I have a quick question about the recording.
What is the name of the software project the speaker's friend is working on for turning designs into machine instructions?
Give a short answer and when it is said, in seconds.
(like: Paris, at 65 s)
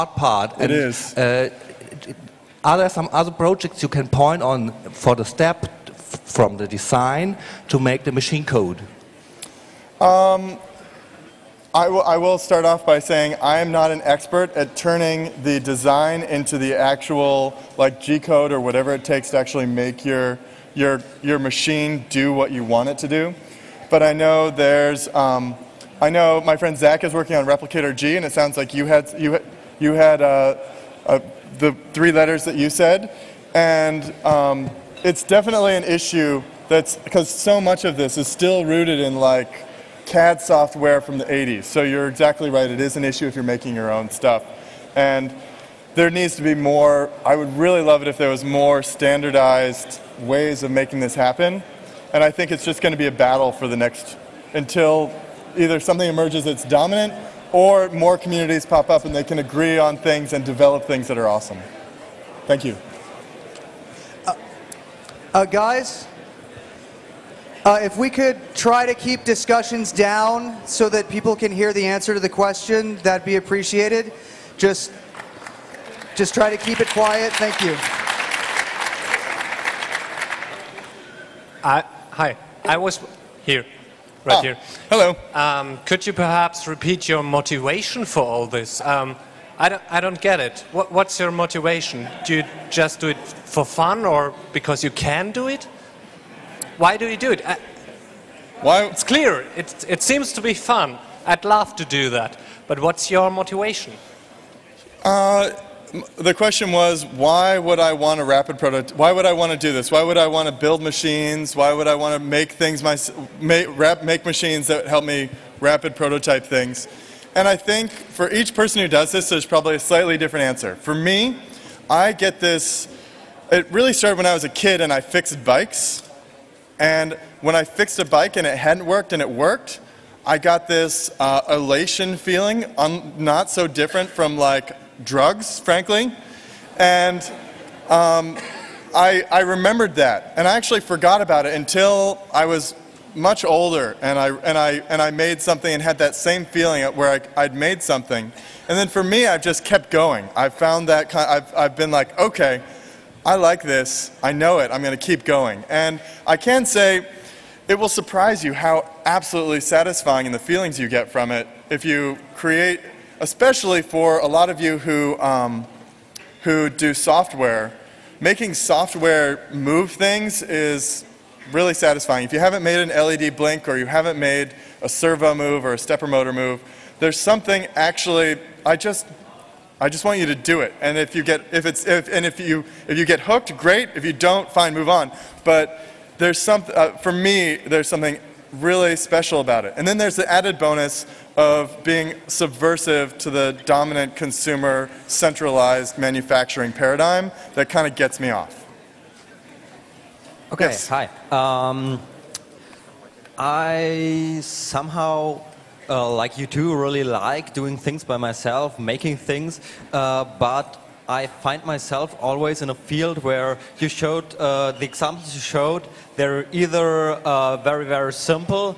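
ReplicatorG, at 27 s.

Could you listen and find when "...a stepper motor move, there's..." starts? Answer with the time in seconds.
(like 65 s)
175 s.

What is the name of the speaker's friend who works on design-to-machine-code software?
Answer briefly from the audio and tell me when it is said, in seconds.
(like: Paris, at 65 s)
Zach, at 26 s.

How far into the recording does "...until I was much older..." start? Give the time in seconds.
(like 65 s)
141 s.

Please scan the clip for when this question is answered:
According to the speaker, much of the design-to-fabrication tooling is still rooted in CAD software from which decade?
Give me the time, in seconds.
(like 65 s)
41 s.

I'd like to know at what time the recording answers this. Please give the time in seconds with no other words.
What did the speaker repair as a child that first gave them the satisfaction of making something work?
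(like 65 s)
125 s.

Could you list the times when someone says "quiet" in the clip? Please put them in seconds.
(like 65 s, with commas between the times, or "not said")
76 s.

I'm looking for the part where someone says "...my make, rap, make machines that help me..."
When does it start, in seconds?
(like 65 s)
112 s.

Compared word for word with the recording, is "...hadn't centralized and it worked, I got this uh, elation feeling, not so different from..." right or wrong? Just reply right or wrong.
wrong.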